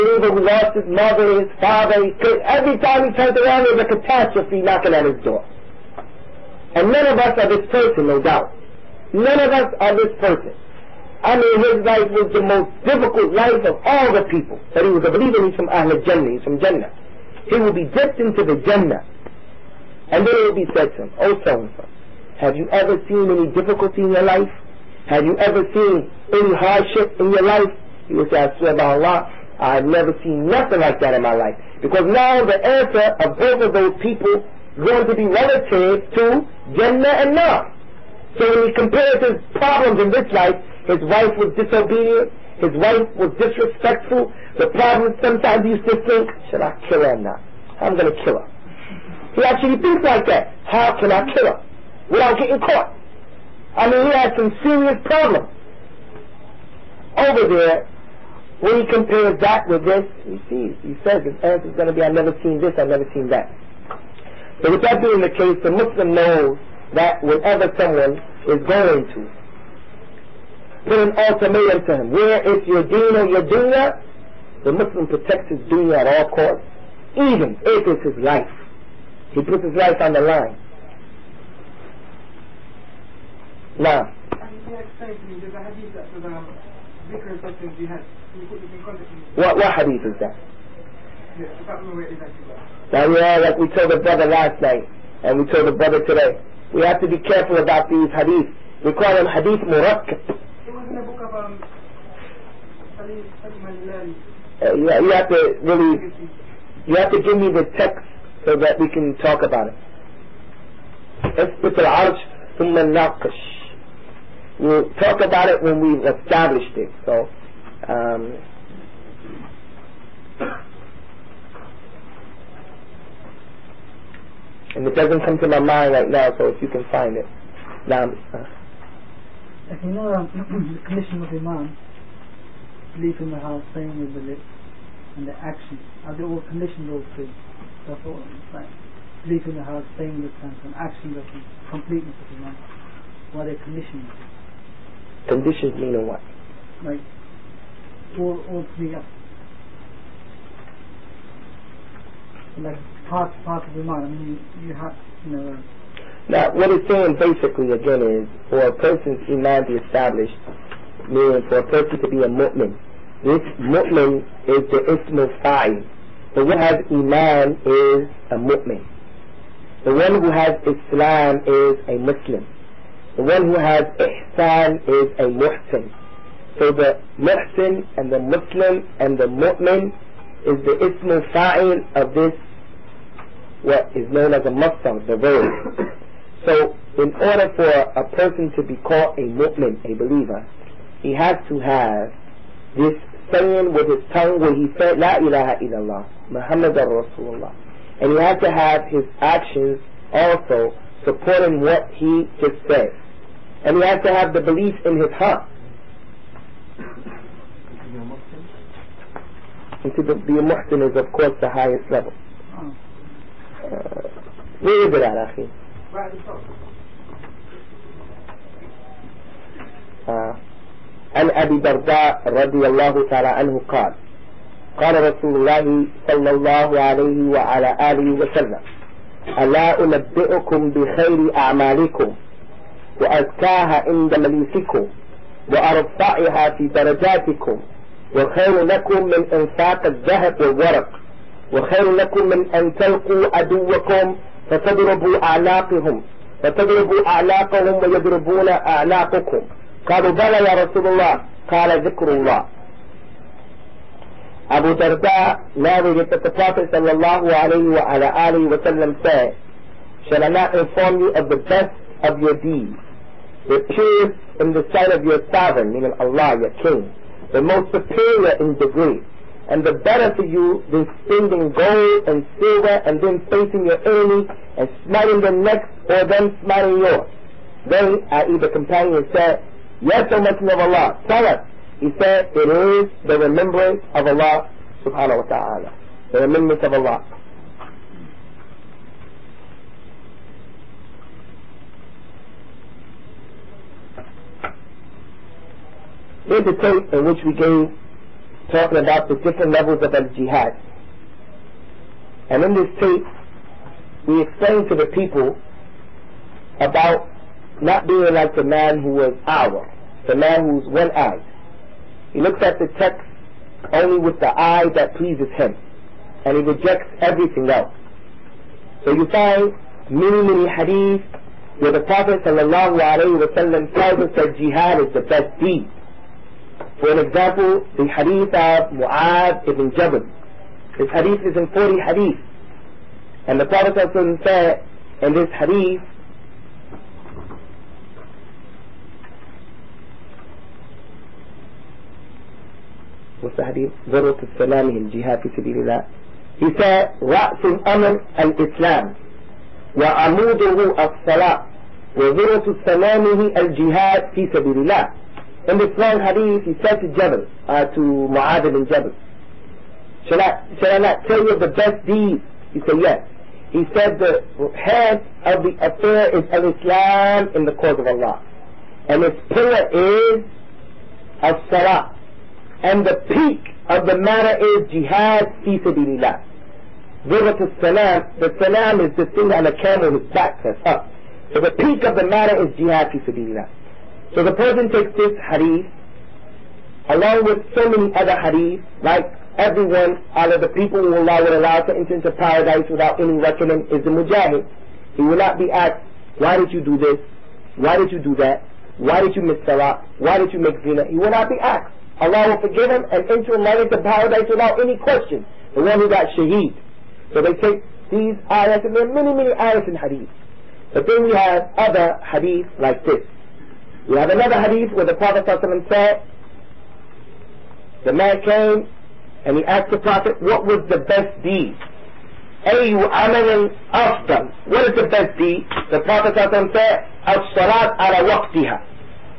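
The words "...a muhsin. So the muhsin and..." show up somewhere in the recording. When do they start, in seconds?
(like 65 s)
175 s.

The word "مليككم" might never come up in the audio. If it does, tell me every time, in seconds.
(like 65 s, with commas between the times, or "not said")
234 s.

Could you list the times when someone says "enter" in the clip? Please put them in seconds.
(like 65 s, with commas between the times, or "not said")
391 s, 403 s.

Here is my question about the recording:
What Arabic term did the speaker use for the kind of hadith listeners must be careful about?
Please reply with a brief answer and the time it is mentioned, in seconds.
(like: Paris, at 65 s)
hadith murakkab, at 99 s.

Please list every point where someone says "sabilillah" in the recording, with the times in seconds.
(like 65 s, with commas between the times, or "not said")
375 s, 383 s.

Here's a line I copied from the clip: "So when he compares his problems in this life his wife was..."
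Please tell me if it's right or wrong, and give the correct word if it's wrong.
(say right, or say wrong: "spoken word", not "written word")
right.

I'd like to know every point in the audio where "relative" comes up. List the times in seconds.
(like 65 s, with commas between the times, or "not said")
35 s.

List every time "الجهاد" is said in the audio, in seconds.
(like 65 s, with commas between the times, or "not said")
344 s, 353 s.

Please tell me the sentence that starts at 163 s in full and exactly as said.
This mu'min is the ismul The one who has iman is a mu'min.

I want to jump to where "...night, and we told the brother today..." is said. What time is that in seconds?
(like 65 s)
94 s.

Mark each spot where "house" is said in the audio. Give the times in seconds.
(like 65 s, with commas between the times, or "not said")
133 s, 139 s.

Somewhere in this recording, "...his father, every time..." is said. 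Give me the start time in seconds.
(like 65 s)
1 s.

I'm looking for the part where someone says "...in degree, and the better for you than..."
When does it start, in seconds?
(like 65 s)
268 s.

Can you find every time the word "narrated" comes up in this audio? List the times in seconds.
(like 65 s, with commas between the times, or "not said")
255 s.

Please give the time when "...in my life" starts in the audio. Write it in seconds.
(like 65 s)
31 s.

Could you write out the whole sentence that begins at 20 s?
And then it will be said to him, Oh so-and-so, have you ever seen any difficulty in your life?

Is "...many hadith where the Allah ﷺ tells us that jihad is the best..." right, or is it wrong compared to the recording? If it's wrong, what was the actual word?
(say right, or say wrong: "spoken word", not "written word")
wrong: "Prophet", not "Allah".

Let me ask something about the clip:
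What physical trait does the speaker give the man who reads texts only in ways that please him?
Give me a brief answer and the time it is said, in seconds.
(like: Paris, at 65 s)
One-eyed, at 310 s.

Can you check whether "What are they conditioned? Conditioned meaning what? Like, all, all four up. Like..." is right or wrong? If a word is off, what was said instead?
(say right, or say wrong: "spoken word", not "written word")
wrong: "three", not "four".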